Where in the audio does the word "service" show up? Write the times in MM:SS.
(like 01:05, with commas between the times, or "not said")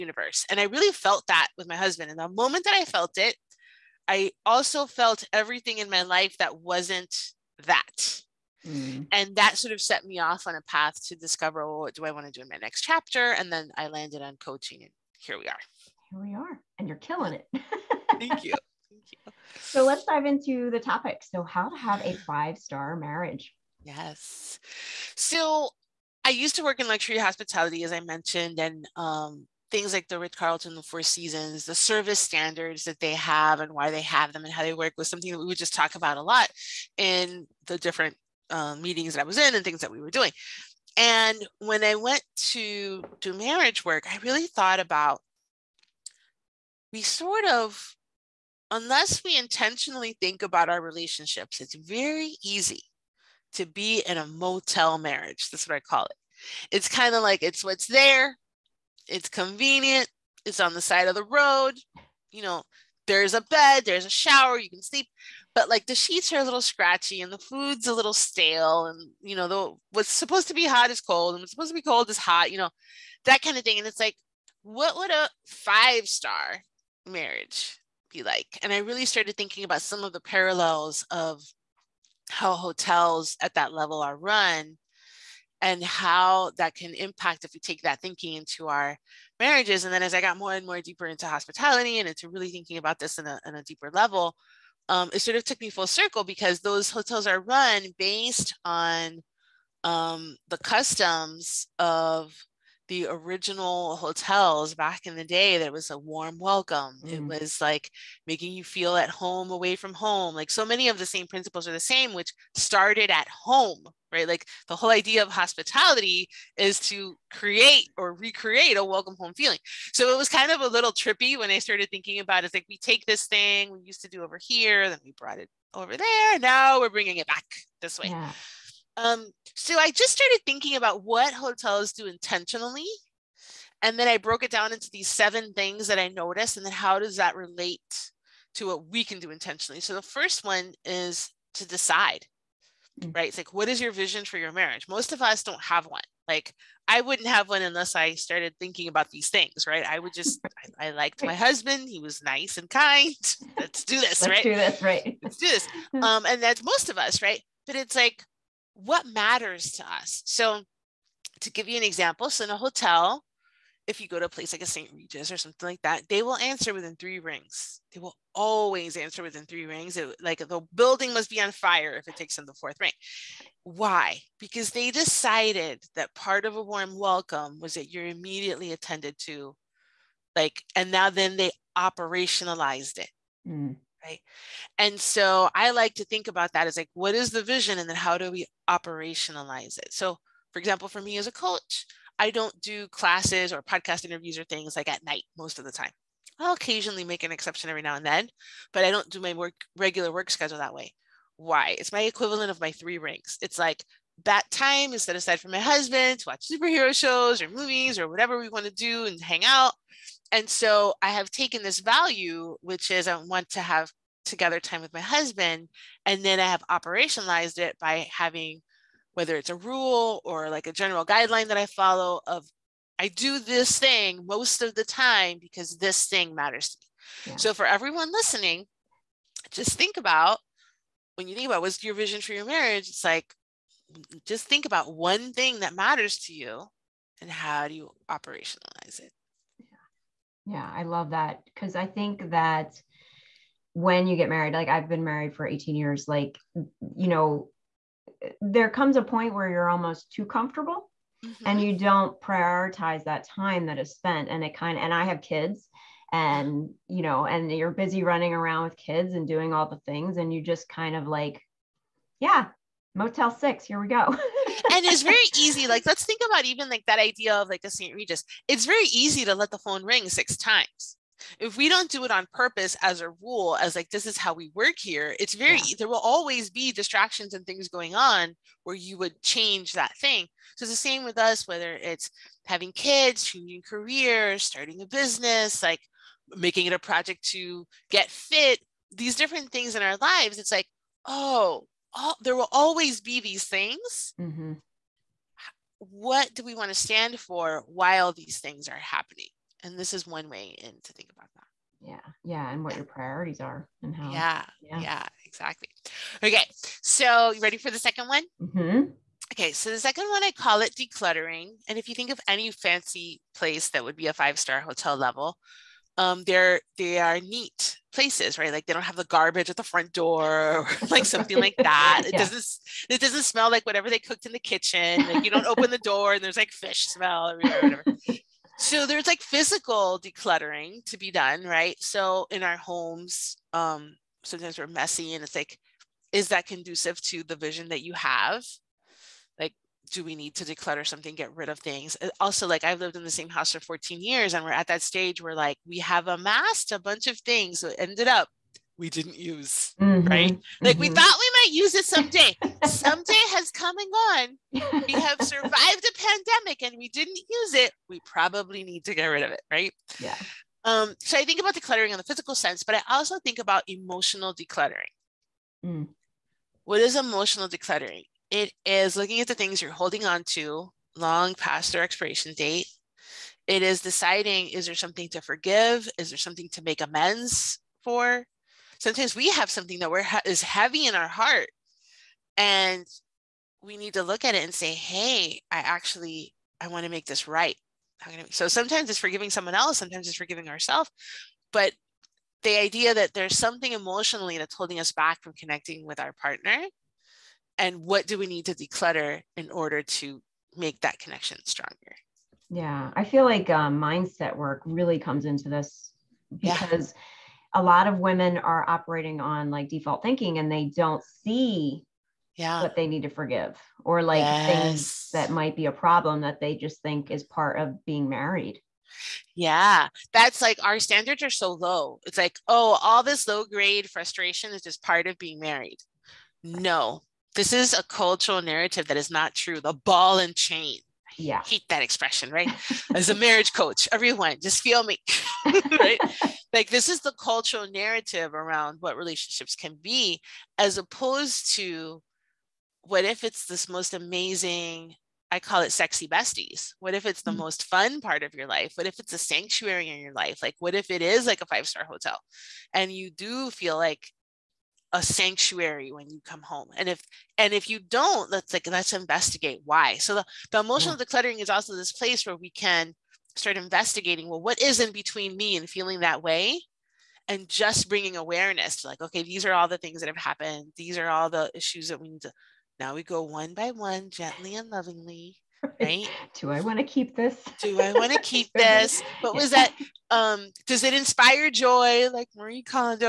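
00:31.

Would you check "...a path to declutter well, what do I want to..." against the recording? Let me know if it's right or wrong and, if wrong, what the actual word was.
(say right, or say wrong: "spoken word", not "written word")
wrong: "discover", not "declutter".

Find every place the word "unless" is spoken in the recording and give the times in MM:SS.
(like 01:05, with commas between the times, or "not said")
00:48, 02:27.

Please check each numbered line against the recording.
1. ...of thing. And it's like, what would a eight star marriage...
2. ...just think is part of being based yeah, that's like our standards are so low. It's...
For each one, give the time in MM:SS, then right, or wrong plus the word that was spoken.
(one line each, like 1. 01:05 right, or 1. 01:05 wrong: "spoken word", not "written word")
1. 01:13 wrong: "five", not "eight"
2. 06:56 wrong: "married", not "based".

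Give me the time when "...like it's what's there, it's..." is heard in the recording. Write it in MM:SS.
00:57.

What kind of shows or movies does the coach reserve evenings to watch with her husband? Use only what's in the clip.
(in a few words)
superhero.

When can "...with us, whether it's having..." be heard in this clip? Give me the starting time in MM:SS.
04:41.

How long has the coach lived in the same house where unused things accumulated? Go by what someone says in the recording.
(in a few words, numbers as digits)
14 years.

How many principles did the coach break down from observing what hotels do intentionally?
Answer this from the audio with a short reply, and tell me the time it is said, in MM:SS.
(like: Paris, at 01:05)
7, at 02:15.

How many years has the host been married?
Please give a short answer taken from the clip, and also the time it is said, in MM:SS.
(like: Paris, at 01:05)
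18, at 04:05.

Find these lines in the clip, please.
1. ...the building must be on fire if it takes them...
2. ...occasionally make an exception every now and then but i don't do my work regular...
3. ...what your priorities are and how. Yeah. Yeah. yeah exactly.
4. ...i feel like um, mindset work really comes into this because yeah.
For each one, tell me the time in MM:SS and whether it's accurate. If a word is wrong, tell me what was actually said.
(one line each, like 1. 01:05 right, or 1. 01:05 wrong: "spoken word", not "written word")
1. 02:50 right
2. 03:16 right
3. 05:02 right
4. 06:42 right.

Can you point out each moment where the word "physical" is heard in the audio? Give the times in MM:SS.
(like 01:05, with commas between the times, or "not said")
05:29, 06:02.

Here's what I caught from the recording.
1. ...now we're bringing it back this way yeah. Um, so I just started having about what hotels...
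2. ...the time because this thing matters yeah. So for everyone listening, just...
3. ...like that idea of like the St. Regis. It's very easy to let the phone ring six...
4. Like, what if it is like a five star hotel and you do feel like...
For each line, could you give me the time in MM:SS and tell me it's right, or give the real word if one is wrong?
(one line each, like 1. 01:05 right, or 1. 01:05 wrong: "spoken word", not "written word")
1. 02:06 wrong: "thinking", not "having"
2. 03:44 right
3. 04:26 right
4. 07:30 right.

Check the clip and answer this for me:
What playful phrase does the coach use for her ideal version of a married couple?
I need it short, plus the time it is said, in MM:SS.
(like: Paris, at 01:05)
sexy besties, at 07:25.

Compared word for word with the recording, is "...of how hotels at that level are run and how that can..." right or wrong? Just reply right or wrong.
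right.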